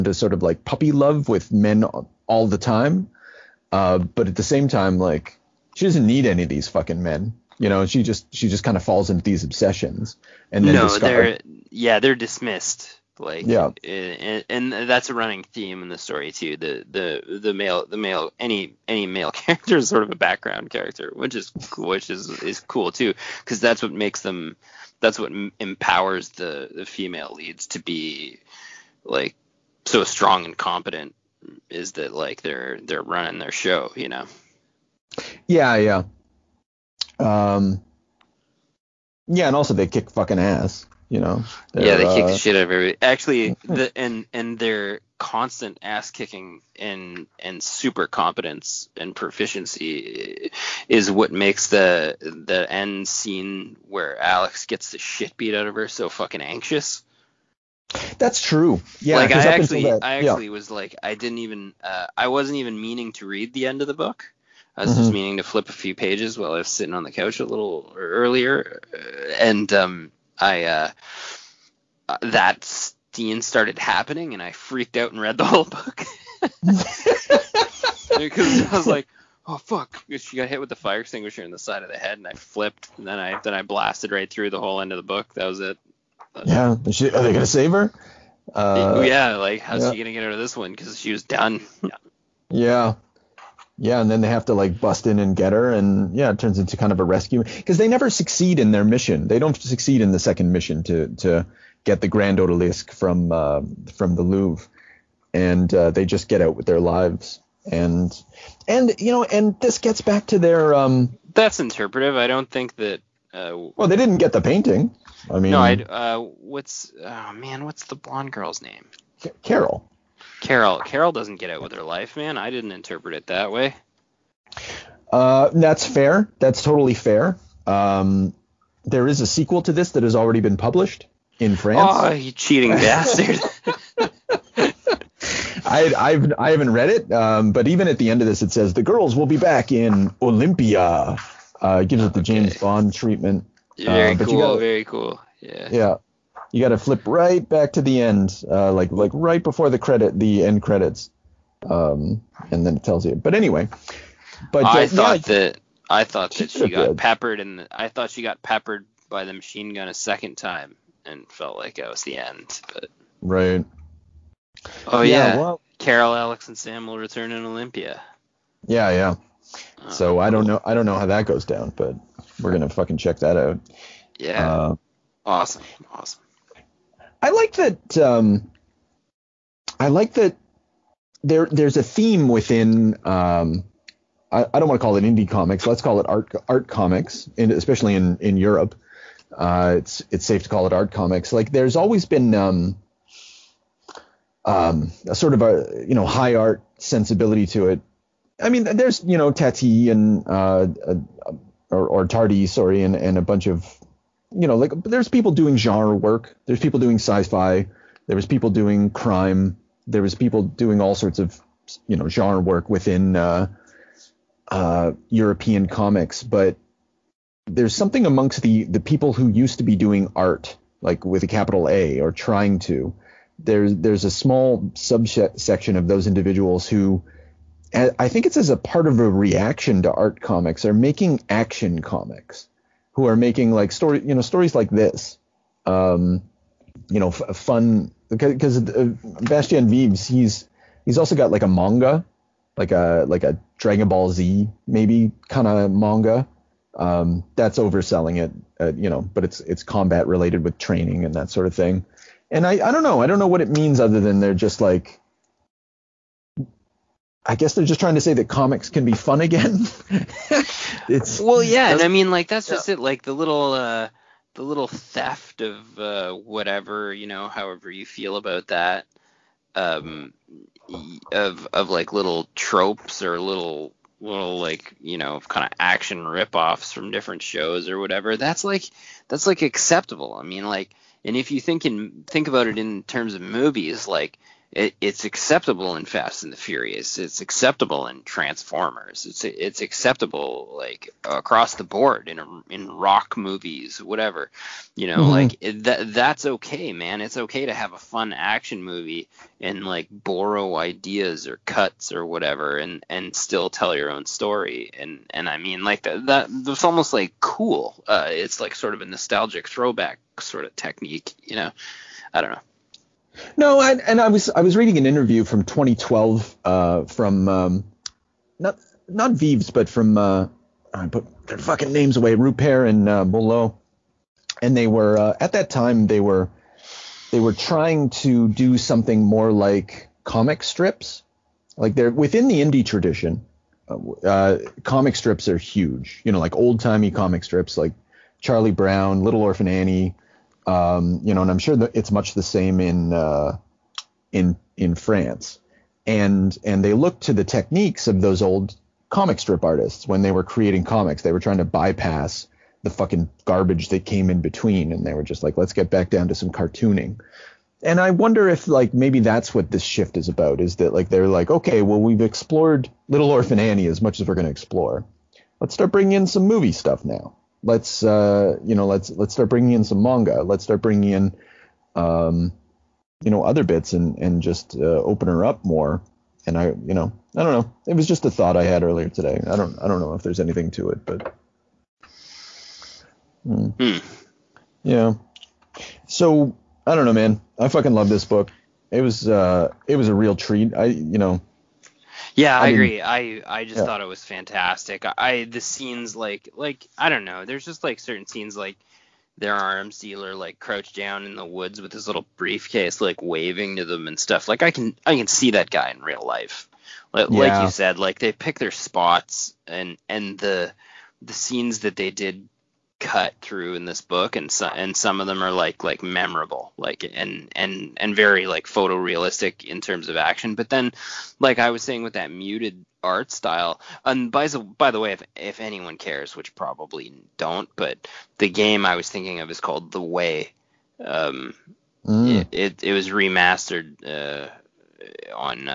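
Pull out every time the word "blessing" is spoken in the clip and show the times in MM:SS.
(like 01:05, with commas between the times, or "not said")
not said.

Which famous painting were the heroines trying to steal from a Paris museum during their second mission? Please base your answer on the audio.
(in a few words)
Grande Odalisque.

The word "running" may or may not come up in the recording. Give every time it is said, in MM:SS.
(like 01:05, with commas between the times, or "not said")
00:15, 00:33.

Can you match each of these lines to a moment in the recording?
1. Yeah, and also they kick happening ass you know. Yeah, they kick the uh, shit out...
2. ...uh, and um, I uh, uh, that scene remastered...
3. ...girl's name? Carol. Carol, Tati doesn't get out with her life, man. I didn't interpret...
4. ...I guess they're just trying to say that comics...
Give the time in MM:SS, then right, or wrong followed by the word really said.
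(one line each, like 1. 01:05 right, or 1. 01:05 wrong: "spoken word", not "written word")
1. 00:39 wrong: "fucking", not "happening"
2. 01:08 wrong: "started", not "remastered"
3. 01:58 wrong: "Carol", not "Tati"
4. 04:17 right.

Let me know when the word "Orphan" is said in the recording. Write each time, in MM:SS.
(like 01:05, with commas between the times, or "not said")
05:39, 06:03.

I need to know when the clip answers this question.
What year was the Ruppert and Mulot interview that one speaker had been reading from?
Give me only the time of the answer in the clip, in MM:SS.
05:15.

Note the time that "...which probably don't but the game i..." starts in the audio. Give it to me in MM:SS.
07:06.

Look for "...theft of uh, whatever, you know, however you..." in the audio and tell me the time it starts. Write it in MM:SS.
04:24.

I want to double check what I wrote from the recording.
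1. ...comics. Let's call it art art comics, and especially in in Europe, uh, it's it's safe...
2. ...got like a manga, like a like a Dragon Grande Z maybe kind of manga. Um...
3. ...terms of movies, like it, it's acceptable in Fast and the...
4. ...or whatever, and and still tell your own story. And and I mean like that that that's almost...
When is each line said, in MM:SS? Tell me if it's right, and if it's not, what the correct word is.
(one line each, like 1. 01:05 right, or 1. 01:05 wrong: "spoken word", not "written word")
1. 03:05 right
2. 04:01 wrong: "Ball", not "Grande"
3. 04:42 right
4. 05:01 right.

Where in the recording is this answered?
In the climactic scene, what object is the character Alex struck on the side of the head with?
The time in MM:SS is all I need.
01:20.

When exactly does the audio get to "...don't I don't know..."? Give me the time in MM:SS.
06:19.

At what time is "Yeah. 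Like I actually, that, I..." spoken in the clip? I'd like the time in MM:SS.
00:59.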